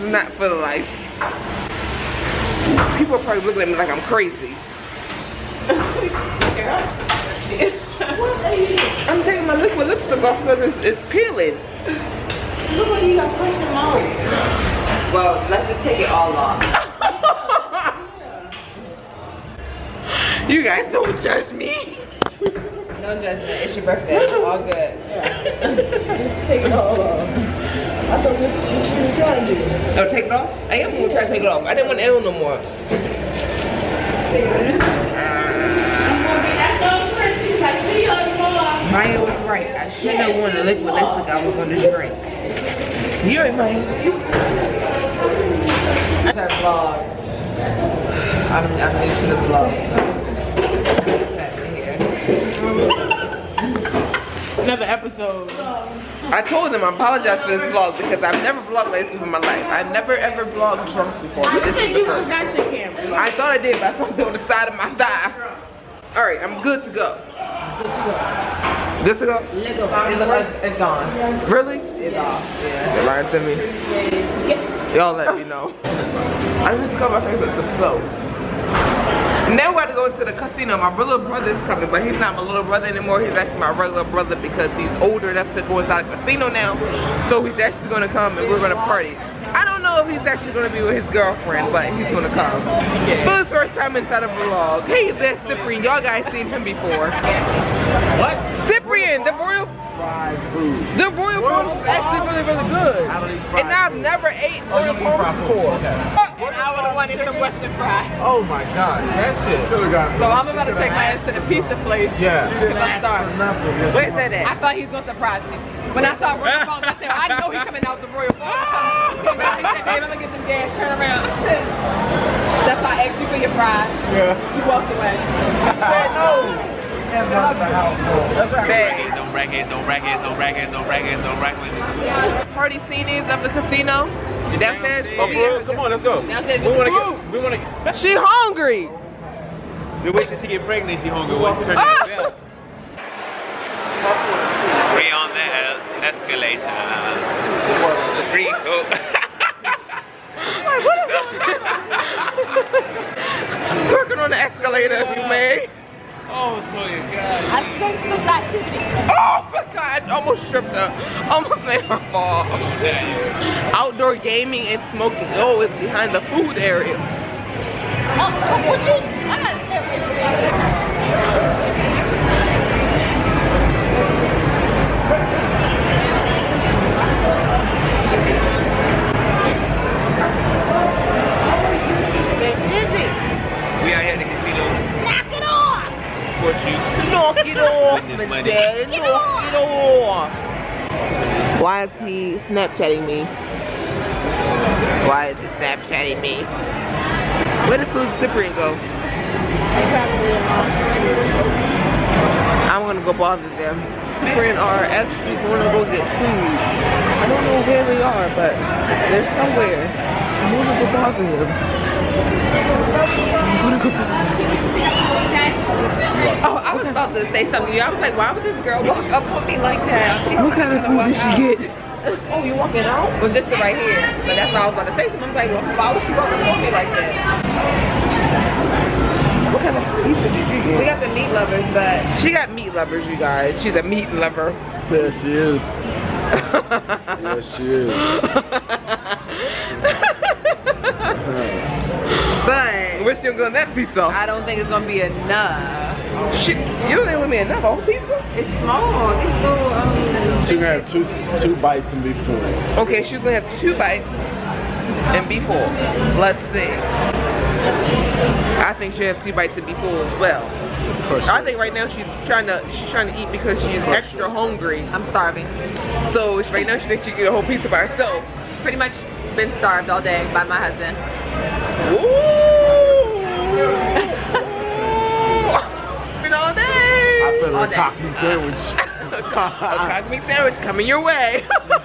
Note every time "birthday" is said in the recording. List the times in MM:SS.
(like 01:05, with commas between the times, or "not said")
00:23.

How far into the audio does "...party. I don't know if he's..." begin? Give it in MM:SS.
01:28.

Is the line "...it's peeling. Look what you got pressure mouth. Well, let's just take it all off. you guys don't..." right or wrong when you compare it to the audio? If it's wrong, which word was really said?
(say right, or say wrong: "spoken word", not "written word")
right.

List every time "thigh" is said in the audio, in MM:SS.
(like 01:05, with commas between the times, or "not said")
01:04.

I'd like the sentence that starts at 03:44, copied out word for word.
But that's what I was about to say.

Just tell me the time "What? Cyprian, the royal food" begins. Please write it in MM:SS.
01:38.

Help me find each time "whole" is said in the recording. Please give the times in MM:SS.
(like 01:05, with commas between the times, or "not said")
04:07, 04:27.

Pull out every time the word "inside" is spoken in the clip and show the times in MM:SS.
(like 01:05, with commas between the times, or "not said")
01:25, 01:33.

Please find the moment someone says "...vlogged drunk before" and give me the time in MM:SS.
01:00.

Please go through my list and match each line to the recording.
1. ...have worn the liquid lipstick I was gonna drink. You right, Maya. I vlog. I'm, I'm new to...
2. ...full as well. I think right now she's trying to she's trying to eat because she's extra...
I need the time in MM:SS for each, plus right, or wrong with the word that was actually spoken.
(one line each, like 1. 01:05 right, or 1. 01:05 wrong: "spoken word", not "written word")
1. 00:40 right
2. 04:19 right.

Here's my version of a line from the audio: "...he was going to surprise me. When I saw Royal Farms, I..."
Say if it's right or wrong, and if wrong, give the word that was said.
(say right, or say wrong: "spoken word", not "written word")
right.